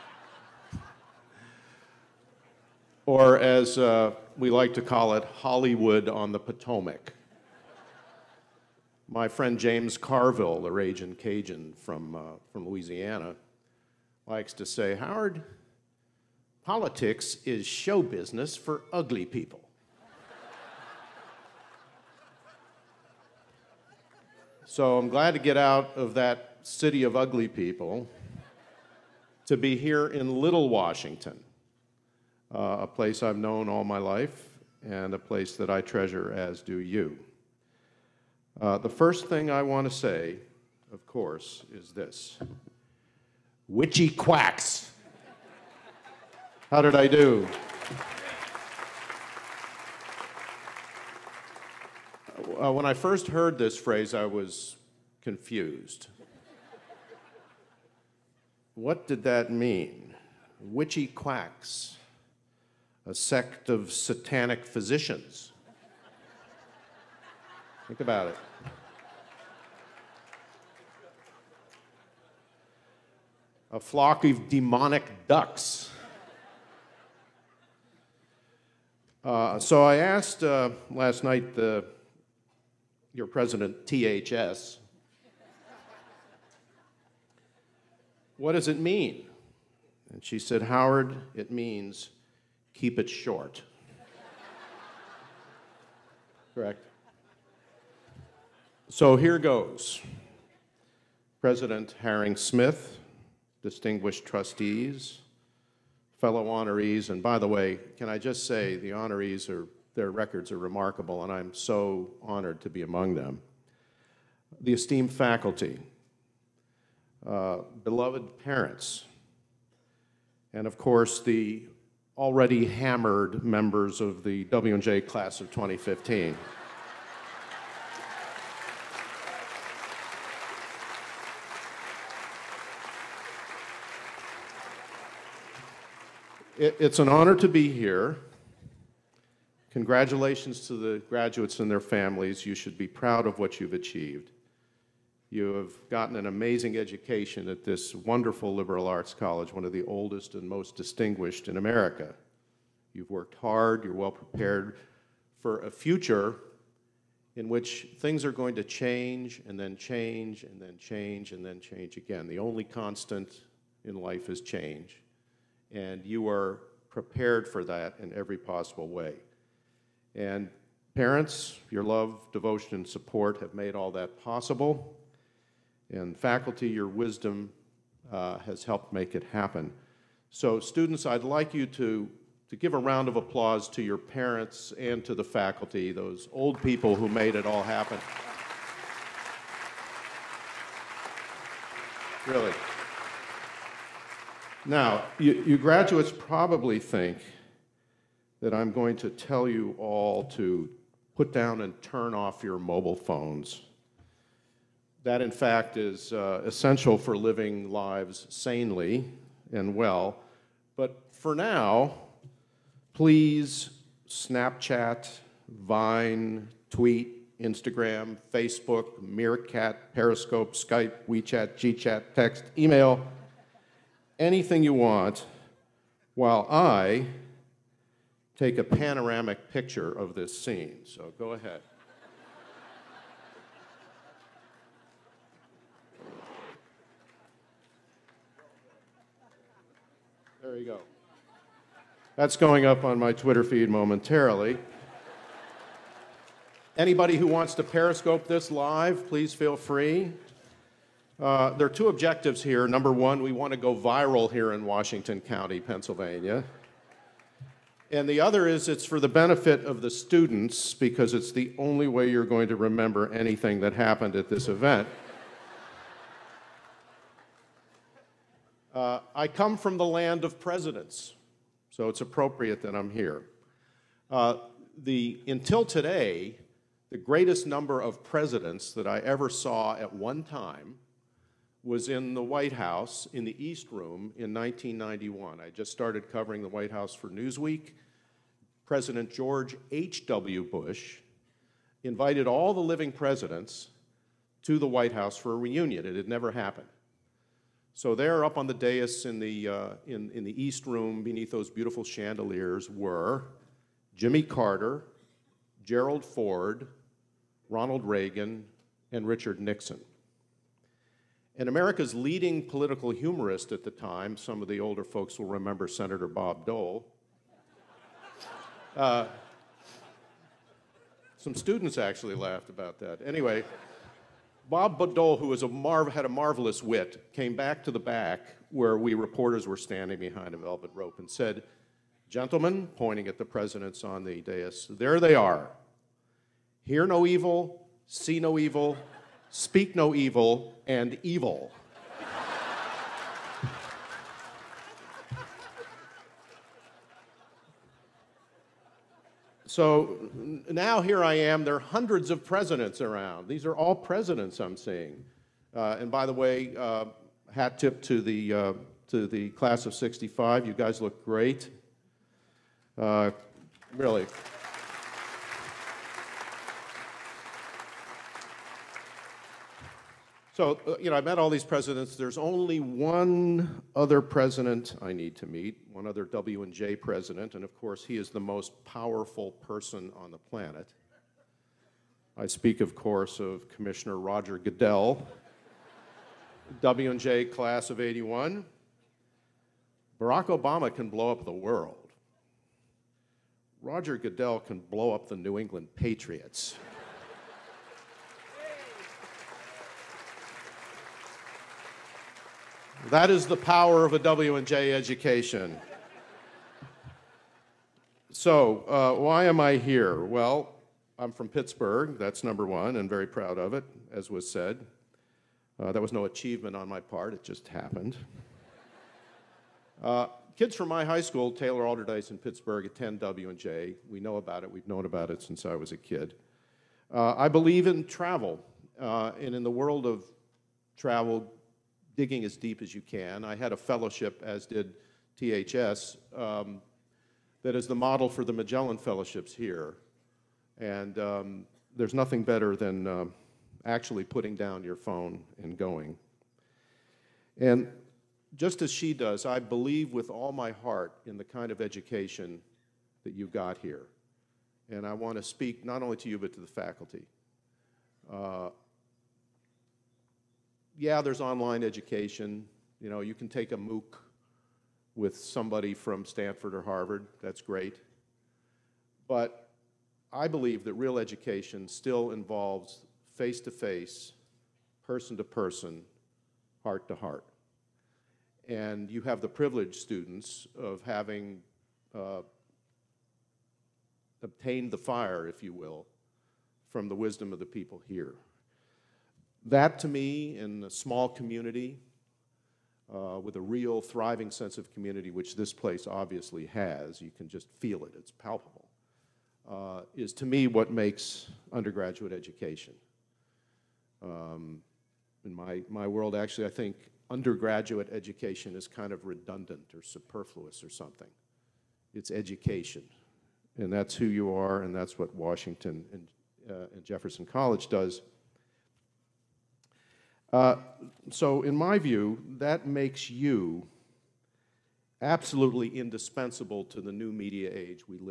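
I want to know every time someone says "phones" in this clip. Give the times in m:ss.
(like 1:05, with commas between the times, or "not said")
3:22, 7:24.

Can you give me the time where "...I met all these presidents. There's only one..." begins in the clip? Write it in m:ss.
6:10.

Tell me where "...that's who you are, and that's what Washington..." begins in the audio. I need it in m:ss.
8:33.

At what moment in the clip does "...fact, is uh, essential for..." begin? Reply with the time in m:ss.
3:25.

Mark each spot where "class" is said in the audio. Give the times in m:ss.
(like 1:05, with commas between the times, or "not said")
2:05, 5:59, 6:27.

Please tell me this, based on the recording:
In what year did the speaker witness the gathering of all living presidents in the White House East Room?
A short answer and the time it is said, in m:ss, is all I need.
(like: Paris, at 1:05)
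1991, at 4:44.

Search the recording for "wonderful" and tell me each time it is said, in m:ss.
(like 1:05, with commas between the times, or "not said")
2:27.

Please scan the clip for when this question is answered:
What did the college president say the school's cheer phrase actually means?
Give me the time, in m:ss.
1:32.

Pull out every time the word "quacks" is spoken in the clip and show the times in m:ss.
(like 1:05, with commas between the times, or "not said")
0:44, 1:01.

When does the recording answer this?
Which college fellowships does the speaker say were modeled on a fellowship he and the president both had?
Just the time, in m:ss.
7:18.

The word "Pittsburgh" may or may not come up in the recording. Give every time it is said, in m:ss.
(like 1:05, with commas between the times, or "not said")
6:51, 7:02.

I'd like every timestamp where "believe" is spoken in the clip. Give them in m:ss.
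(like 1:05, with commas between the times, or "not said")
7:07, 7:29, 7:50.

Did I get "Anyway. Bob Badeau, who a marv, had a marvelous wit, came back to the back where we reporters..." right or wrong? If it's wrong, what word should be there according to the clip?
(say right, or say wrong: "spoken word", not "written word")
right.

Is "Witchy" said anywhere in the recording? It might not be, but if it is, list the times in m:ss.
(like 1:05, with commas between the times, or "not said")
0:43, 1:00.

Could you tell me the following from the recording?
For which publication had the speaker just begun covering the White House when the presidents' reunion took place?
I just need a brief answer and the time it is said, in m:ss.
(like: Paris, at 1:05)
Newsweek, at 4:47.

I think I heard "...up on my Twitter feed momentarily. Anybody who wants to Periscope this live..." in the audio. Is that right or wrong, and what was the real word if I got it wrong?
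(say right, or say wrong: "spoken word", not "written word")
right.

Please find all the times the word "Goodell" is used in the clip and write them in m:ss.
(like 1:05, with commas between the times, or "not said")
6:24, 6:33.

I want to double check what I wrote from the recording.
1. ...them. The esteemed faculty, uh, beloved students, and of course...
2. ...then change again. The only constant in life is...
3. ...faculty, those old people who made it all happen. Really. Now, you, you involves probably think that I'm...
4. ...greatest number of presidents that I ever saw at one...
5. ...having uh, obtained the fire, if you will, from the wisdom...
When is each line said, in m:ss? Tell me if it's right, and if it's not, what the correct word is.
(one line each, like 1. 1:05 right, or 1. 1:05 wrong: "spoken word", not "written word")
1. 1:53 wrong: "parents", not "students"
2. 2:41 right
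3. 3:05 wrong: "graduates", not "involves"
4. 4:36 right
5. 8:00 right.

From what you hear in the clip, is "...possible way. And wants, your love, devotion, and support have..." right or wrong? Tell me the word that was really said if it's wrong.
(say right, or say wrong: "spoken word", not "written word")
wrong: "parents", not "wants".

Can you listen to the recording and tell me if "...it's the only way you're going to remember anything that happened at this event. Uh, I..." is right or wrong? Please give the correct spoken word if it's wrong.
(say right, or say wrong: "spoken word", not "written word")
right.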